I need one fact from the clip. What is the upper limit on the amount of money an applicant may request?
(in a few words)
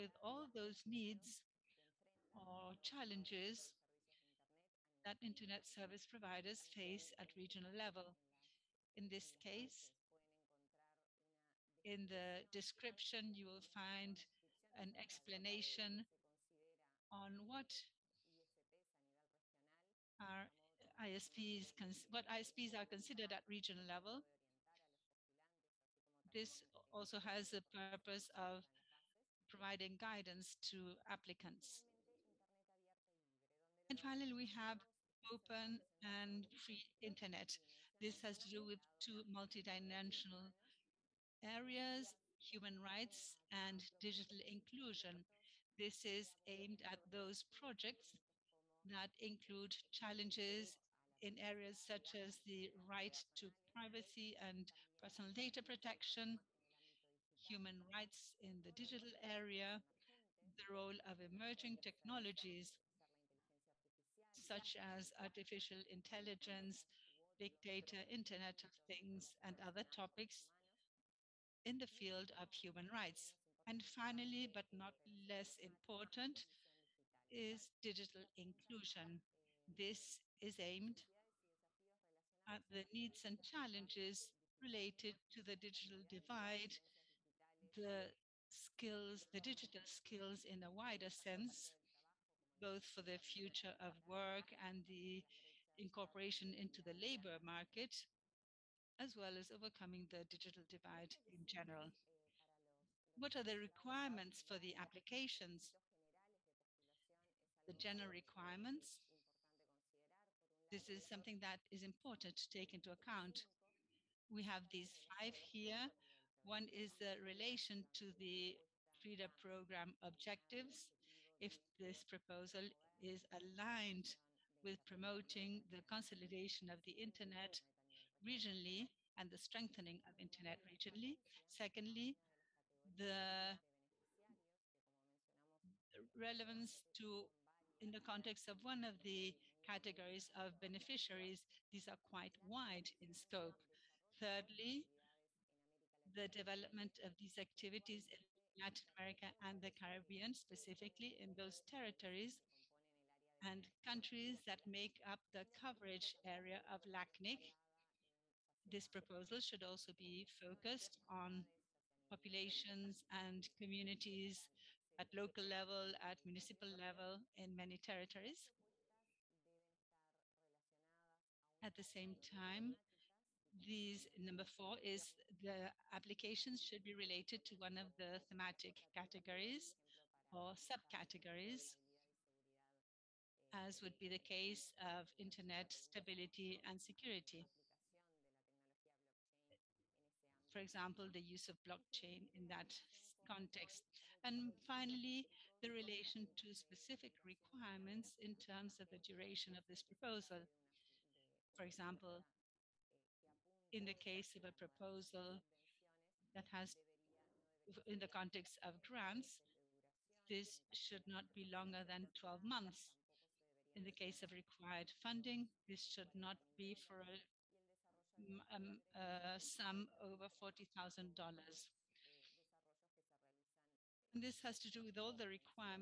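$40,000.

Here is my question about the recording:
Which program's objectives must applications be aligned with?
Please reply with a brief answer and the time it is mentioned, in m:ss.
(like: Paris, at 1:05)
FRIDA, at 1:58.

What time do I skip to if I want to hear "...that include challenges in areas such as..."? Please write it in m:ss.
0:48.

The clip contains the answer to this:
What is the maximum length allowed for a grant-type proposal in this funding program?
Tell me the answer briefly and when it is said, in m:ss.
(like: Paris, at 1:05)
12 months, at 3:32.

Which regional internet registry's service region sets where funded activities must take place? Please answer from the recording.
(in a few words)
LACNIC.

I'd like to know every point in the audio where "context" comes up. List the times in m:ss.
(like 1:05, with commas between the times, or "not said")
2:17, 3:13, 3:28.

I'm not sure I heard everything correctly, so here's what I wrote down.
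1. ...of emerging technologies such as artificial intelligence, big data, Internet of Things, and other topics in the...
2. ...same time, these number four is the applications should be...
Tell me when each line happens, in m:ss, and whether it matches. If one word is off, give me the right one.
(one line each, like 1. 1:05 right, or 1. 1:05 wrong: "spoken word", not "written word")
1. 1:01 right
2. 2:51 right.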